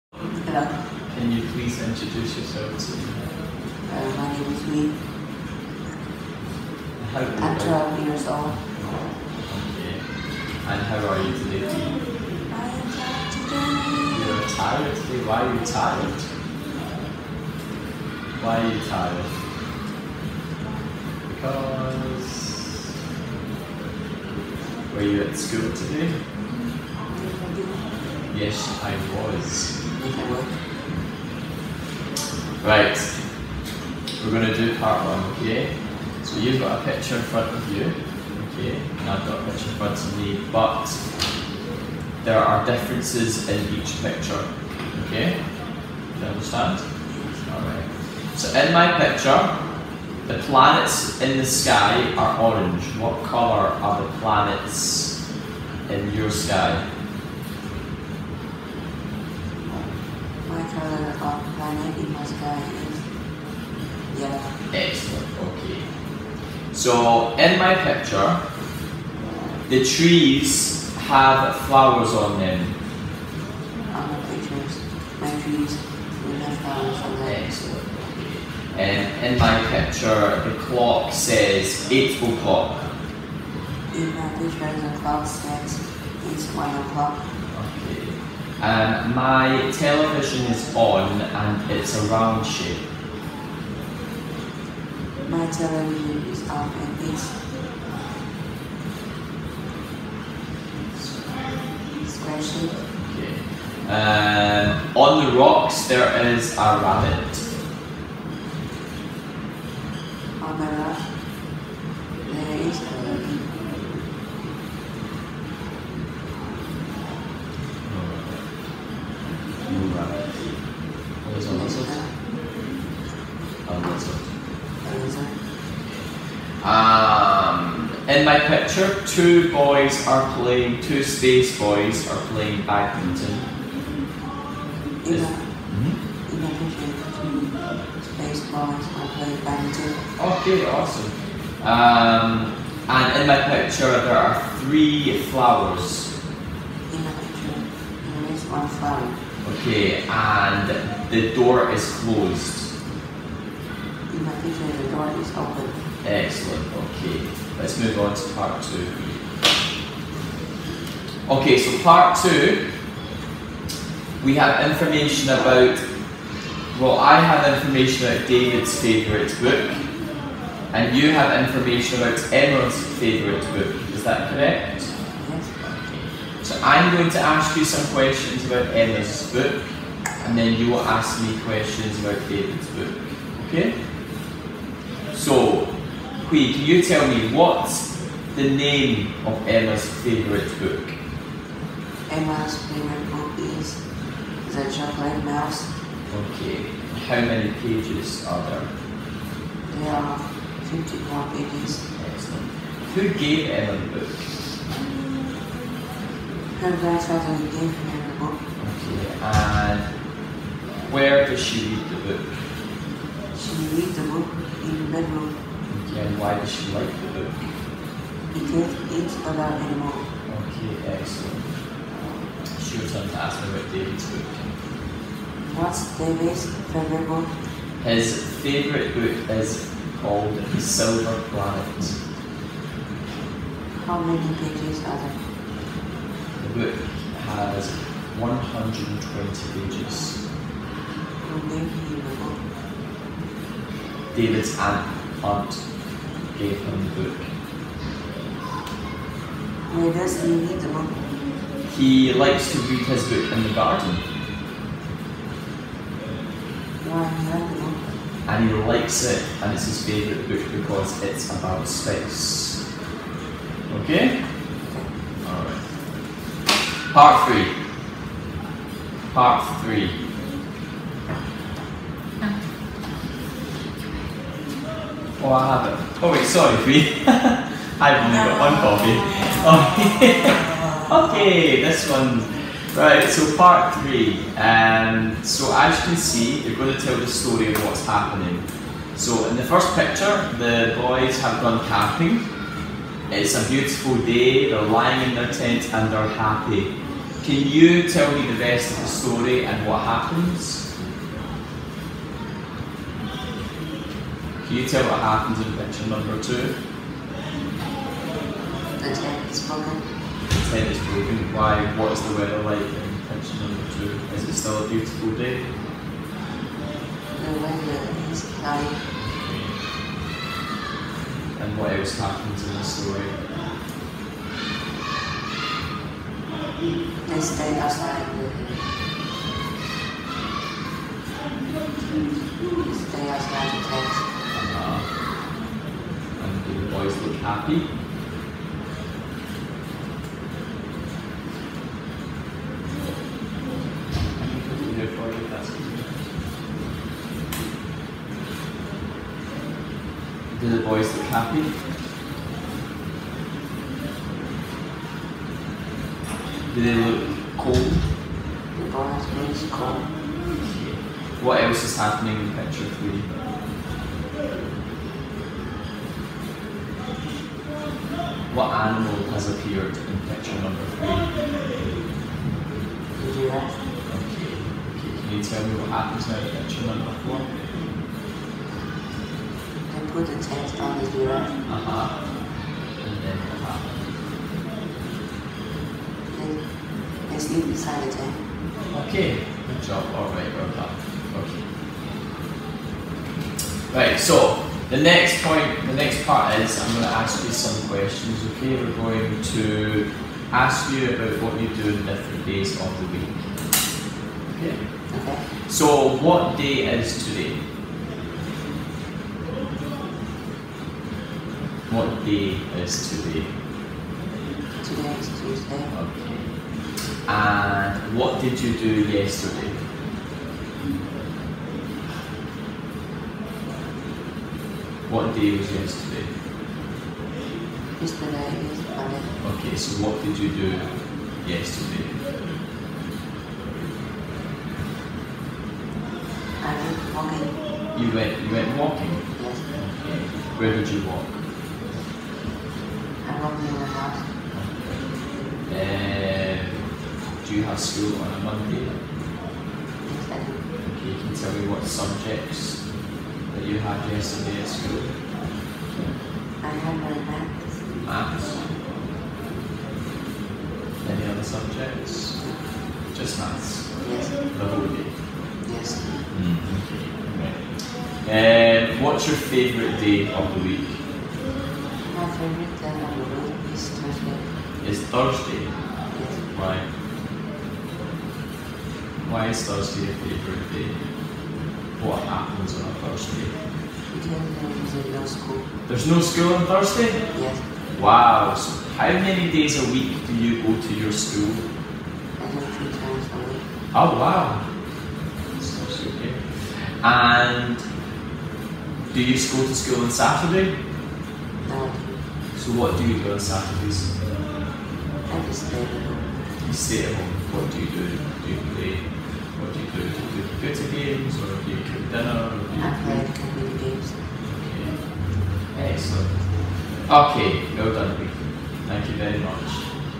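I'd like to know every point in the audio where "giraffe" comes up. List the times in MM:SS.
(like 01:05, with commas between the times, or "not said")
06:13, 06:20.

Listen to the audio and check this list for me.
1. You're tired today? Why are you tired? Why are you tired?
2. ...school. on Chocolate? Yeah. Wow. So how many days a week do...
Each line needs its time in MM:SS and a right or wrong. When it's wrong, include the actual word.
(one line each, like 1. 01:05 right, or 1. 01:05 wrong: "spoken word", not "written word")
1. 00:14 right
2. 08:05 wrong: "Thursday", not "Chocolate".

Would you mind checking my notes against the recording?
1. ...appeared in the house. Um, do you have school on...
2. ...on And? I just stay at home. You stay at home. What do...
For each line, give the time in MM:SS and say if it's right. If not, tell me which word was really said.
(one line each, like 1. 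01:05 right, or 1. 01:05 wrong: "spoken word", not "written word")
1. 07:23 wrong: "walked", not "appeared"
2. 08:23 wrong: "Saturdays", not "And".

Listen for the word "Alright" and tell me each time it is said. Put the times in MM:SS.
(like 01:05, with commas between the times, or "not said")
00:47, 04:25.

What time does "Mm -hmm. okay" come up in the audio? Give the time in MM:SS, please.
07:46.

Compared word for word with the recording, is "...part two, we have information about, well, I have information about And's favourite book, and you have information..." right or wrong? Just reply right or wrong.
wrong.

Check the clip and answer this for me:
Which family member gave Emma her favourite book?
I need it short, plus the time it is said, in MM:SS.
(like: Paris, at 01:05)
her grandfather, at 03:26.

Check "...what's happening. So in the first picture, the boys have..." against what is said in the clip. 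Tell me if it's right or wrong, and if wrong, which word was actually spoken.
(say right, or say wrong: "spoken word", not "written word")
right.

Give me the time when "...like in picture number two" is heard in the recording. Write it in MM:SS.
05:12.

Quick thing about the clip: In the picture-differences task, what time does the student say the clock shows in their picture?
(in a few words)
1 o'clock.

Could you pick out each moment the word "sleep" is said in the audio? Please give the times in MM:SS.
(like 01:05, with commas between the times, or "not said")
06:27.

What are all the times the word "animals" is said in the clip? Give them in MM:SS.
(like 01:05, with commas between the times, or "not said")
03:39, 06:08.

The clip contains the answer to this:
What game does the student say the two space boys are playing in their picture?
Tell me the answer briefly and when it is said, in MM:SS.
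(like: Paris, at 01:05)
badminton, at 02:12.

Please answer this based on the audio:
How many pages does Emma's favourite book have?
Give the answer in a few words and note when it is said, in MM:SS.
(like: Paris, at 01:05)
54, at 03:20.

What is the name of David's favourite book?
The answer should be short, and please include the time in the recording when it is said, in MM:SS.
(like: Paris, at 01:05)
The Silver Planet, at 03:50.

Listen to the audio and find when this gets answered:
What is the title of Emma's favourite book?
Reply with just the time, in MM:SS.
03:14.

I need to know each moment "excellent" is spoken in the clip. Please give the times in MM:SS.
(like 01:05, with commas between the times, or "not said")
01:04, 01:17, 02:36, 03:22, 03:40, 08:35.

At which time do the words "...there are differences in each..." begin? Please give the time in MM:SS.
00:42.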